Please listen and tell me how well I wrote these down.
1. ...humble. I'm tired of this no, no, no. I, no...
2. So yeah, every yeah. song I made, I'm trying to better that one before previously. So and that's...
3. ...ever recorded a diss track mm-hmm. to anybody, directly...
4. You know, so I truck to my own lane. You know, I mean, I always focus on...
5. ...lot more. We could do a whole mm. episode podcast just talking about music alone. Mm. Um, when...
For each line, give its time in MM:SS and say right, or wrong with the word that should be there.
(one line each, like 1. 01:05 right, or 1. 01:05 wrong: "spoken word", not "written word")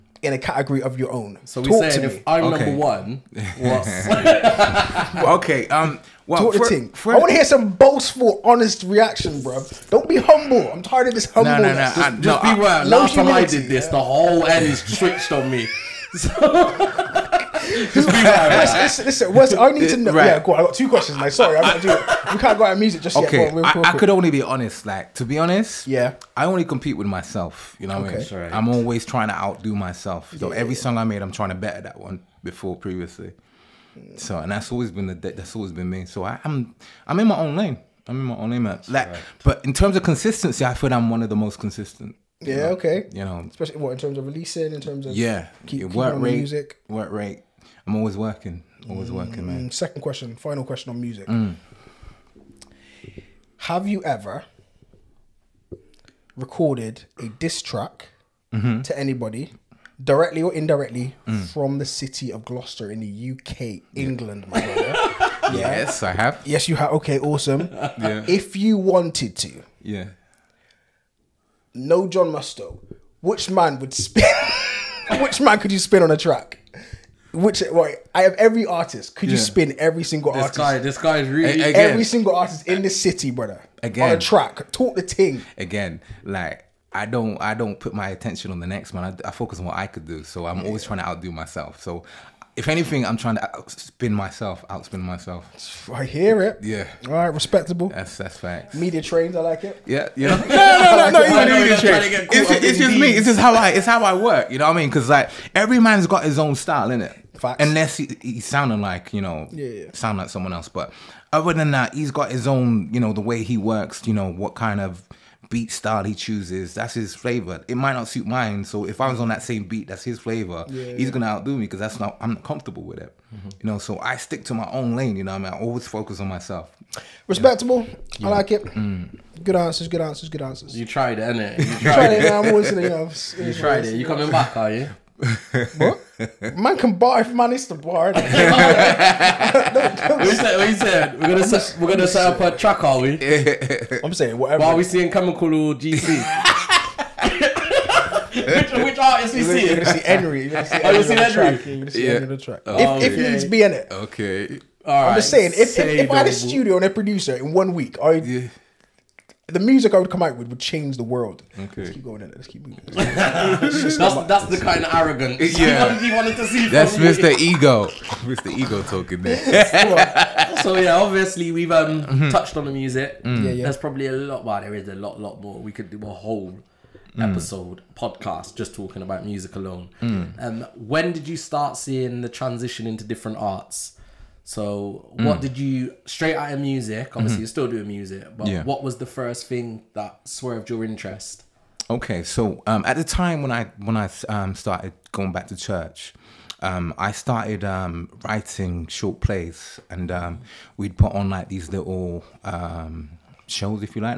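1. 00:10 right
2. 00:30 right
3. 00:54 right
4. 02:03 wrong: "stick", not "truck"
5. 02:55 right.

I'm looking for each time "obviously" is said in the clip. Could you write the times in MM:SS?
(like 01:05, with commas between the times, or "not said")
02:50, 03:07.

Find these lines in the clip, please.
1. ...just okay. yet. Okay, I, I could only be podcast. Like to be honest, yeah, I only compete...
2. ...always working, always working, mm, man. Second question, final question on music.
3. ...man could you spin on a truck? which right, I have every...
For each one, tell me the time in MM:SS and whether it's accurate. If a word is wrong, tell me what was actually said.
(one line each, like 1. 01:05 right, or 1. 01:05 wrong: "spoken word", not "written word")
1. 00:23 wrong: "honest", not "podcast"
2. 00:47 right
3. 01:15 wrong: "track", not "truck".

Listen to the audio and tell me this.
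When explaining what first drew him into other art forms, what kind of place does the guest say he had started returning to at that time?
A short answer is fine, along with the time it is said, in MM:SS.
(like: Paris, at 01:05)
Church, at 03:15.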